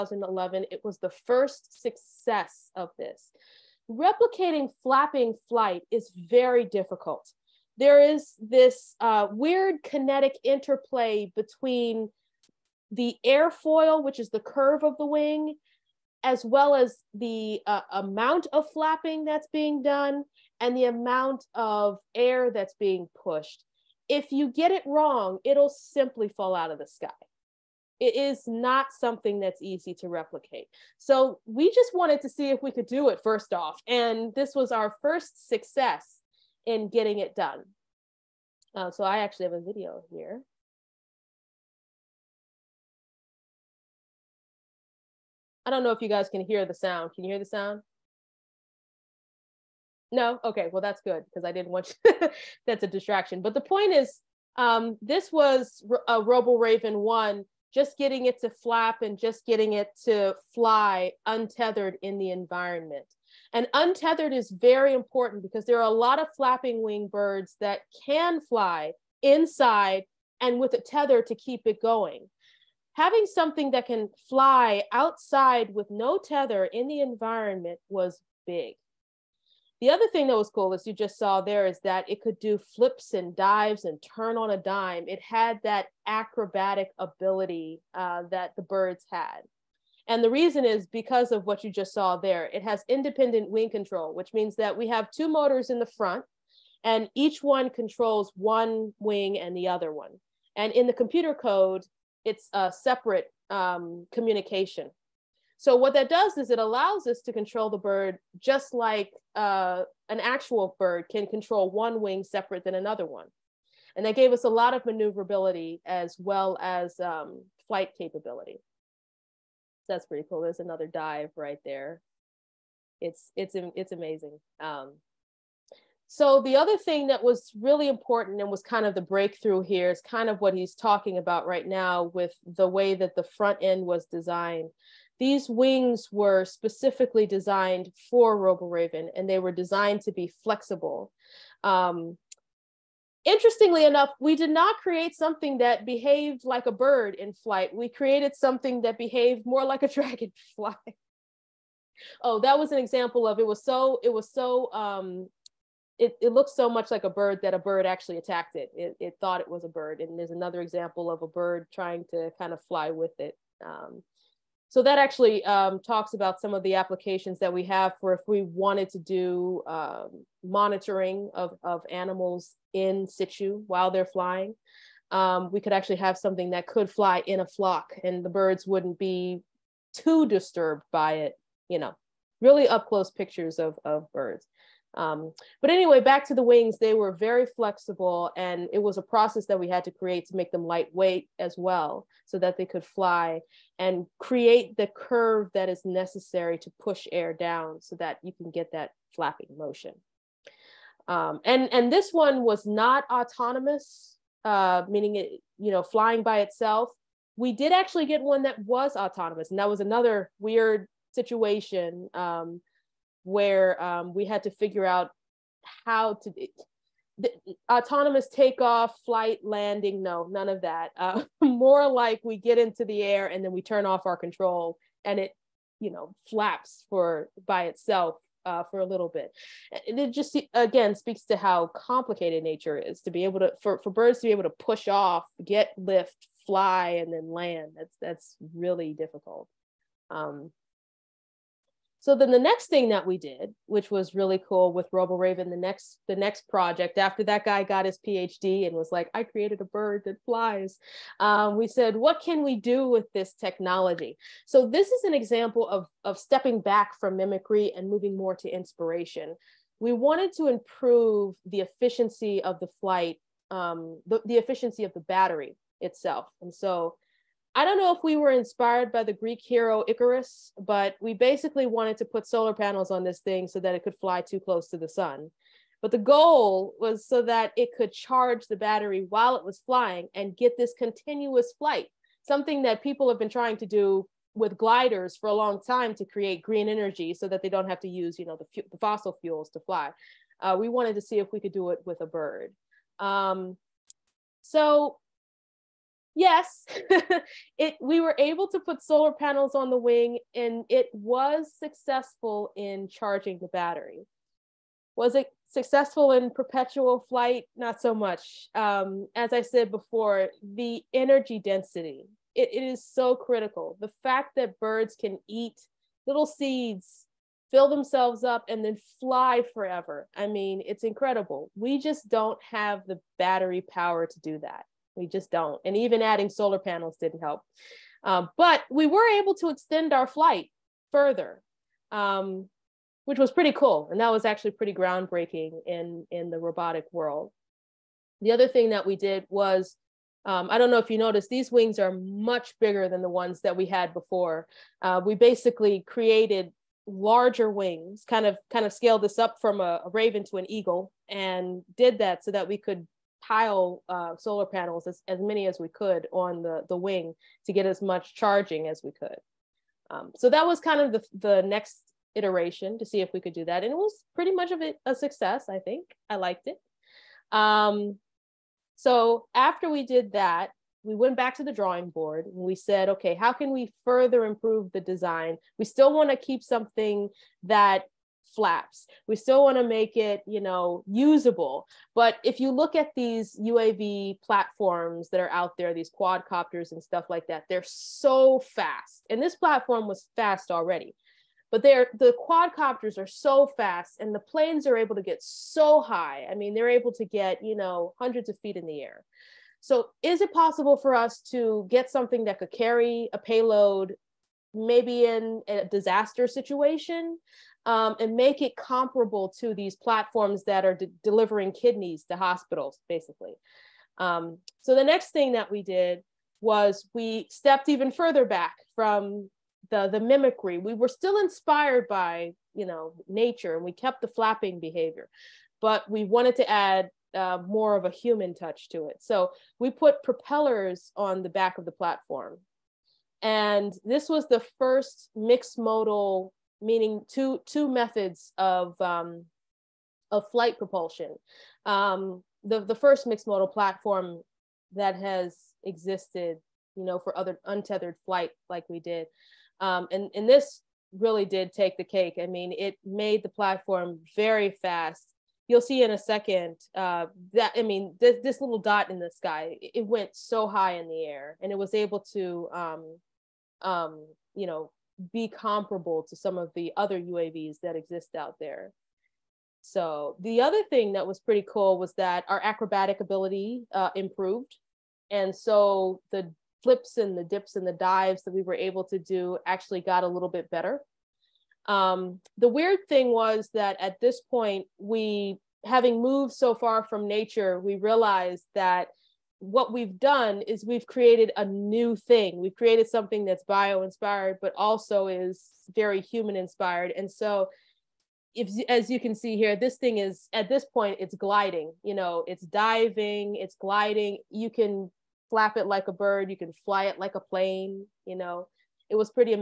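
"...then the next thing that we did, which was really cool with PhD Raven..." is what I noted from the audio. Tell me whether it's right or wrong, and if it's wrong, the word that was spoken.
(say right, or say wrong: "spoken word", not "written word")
wrong: "Robo", not "PhD".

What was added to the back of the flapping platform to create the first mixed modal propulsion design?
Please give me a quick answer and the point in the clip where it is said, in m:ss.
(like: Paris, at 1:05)
propellers, at 7:10.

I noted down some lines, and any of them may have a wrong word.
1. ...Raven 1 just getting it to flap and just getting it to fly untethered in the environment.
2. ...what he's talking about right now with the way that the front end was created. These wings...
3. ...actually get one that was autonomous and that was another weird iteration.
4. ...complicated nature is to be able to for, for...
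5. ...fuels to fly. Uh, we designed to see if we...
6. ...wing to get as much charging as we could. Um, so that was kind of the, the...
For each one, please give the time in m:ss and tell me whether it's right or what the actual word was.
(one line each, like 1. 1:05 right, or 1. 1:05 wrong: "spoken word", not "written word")
1. 0:56 right
2. 2:10 wrong: "designed", not "created"
3. 3:27 wrong: "situation", not "iteration"
4. 3:51 right
5. 4:49 wrong: "wanted", not "designed"
6. 5:56 right.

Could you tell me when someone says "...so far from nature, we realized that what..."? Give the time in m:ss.
8:06.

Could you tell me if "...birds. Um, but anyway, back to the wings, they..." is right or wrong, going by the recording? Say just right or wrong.
right.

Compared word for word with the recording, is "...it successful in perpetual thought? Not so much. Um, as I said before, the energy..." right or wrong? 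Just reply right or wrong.
wrong.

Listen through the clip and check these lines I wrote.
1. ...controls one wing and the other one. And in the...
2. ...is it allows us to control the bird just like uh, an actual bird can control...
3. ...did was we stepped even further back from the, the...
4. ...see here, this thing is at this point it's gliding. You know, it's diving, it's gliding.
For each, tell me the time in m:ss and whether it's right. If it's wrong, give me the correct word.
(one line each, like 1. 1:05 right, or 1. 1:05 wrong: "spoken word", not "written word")
1. 1:37 right
2. 1:46 right
3. 6:55 right
4. 8:19 right.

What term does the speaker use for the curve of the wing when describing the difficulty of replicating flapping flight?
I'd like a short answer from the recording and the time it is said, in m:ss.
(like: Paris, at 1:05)
airfoil, at 0:13.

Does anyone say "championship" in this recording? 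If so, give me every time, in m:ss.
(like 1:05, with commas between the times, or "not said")
not said.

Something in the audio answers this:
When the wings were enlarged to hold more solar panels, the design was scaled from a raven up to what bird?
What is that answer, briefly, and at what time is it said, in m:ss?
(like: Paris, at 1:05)
eagle, at 5:50.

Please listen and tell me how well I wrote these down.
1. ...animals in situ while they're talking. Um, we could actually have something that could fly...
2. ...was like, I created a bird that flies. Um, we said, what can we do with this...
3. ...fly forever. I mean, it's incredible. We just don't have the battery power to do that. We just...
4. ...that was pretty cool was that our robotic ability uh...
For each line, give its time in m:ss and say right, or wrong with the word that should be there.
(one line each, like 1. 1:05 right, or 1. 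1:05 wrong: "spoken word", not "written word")
1. 2:51 wrong: "flying", not "talking"
2. 4:08 right
3. 5:18 right
4. 7:50 wrong: "acrobatic", not "robotic".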